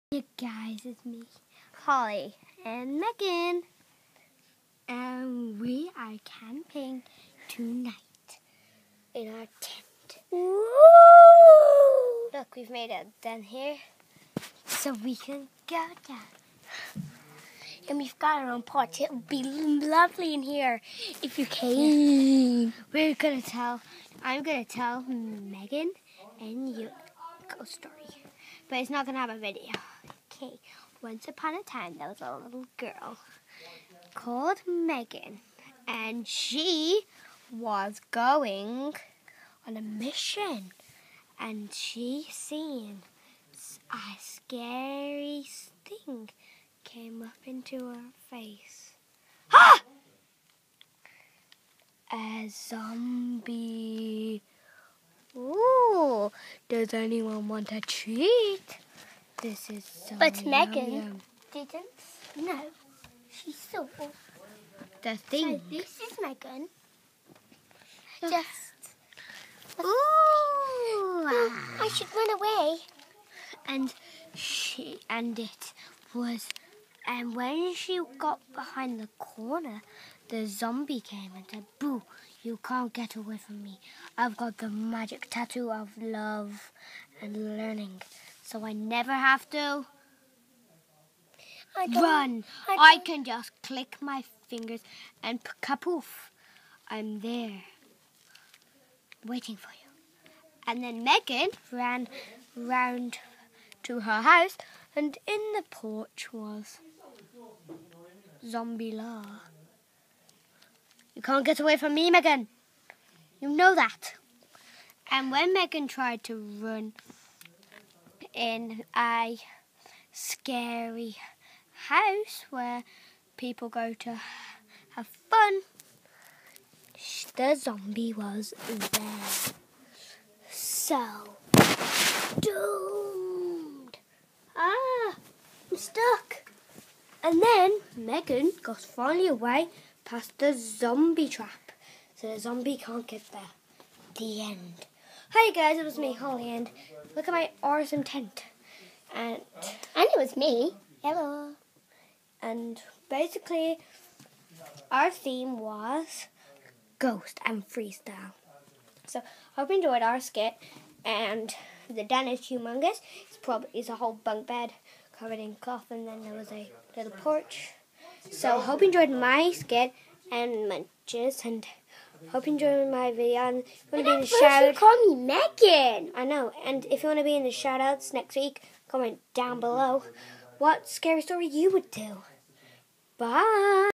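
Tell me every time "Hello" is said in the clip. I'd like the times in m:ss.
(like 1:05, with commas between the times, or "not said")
2:31.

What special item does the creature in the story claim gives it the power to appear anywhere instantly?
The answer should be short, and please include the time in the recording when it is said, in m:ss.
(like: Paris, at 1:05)
Magic tattoo of love and learning, at 1:24.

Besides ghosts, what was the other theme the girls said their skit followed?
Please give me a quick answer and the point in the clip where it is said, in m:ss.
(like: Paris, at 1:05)
Freestyle, at 2:37.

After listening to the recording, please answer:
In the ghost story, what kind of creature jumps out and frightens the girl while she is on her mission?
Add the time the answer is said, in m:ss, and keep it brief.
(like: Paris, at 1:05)
A zombie, at 0:52.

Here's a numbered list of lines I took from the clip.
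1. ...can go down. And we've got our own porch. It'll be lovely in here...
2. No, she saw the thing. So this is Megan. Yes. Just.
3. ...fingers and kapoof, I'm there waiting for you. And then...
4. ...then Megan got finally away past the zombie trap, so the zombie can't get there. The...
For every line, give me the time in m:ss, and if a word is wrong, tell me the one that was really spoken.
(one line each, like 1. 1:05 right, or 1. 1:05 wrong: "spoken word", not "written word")
1. 0:15 right
2. 1:02 right
3. 1:34 right
4. 2:17 right.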